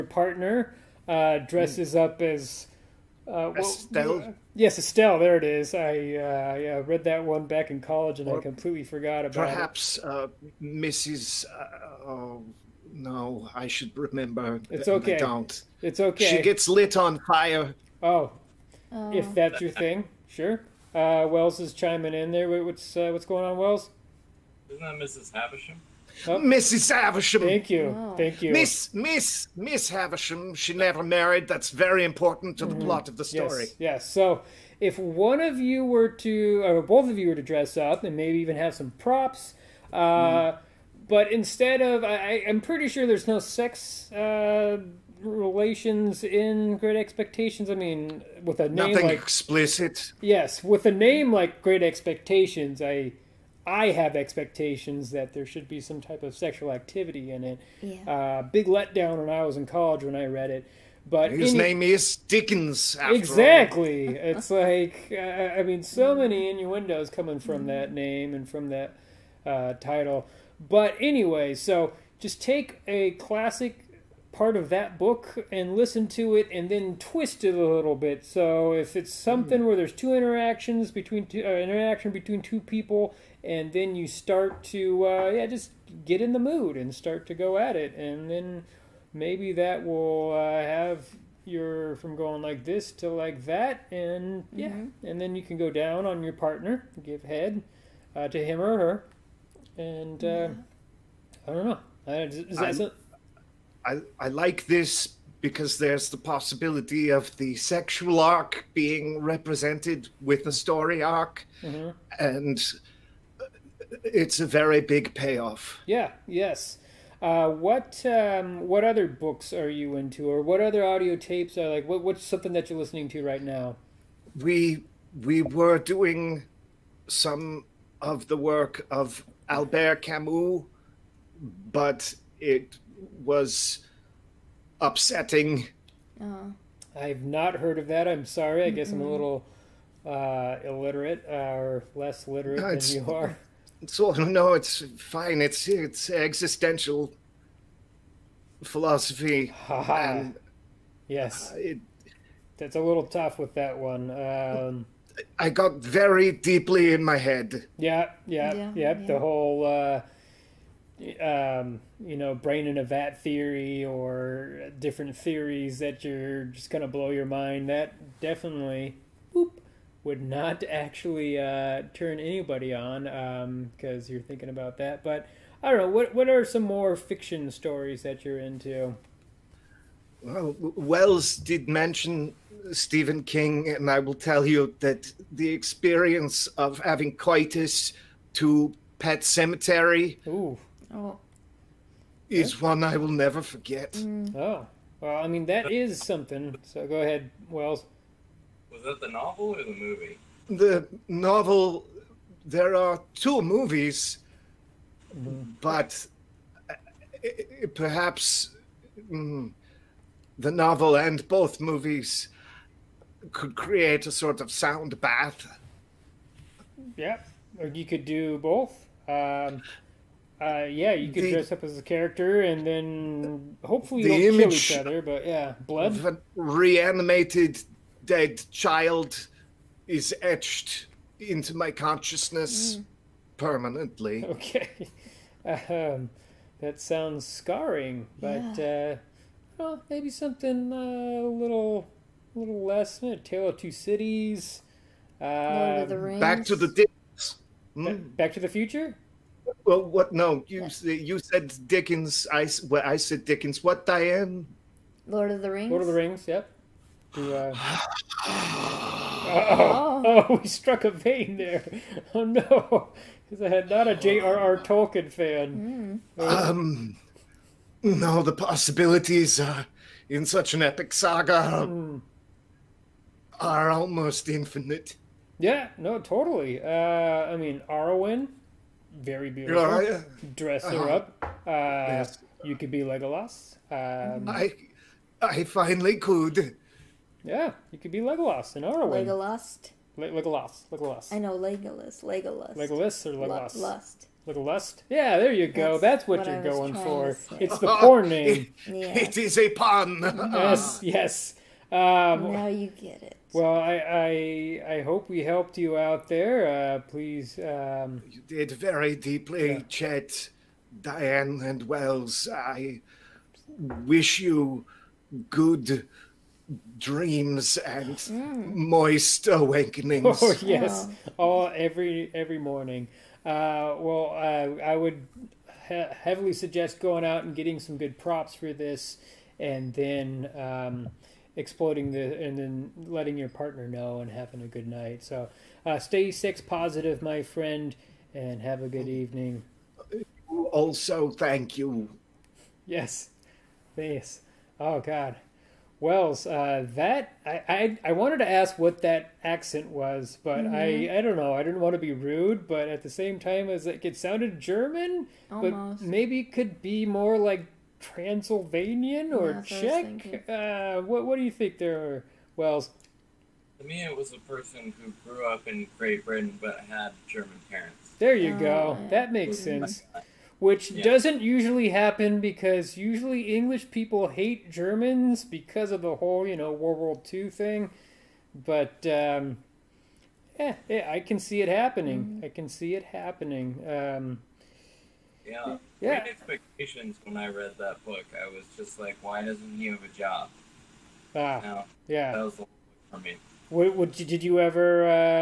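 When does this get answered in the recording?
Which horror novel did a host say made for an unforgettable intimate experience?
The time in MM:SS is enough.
03:08.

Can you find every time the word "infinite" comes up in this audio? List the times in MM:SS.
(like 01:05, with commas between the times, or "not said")
04:34.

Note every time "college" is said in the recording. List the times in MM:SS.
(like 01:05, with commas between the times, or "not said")
00:07, 00:59.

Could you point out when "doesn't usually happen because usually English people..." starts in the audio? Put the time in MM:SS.
06:10.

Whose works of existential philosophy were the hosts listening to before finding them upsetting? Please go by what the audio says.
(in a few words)
Albert Camus.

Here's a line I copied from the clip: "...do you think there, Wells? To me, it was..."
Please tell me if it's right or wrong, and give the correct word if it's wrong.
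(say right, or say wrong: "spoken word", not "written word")
right.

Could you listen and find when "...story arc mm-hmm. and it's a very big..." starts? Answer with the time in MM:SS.
01:50.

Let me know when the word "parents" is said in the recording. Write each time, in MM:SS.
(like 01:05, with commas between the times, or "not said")
06:07.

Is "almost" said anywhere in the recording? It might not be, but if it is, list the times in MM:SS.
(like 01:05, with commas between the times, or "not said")
04:33, 05:55.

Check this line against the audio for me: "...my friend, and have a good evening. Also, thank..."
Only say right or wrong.
right.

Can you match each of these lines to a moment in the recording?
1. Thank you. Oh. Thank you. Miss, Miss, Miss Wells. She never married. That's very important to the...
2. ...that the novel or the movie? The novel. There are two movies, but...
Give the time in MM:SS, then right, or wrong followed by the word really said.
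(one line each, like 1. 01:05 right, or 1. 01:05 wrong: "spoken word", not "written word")
1. 00:27 wrong: "Havisham", not "Wells"
2. 03:18 right.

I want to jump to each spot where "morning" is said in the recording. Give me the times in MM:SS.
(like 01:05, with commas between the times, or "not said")
05:22.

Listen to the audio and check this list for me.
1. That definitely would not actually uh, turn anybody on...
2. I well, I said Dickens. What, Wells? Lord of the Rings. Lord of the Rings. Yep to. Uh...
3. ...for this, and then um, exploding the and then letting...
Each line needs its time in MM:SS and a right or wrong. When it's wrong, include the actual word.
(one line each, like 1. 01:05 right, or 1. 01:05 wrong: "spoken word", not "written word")
1. 02:47 right
2. 04:12 wrong: "Diane", not "Wells"
3. 05:28 right.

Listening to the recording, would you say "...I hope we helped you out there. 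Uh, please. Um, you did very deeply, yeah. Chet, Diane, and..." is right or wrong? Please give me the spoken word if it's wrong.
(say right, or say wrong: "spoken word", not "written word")
right.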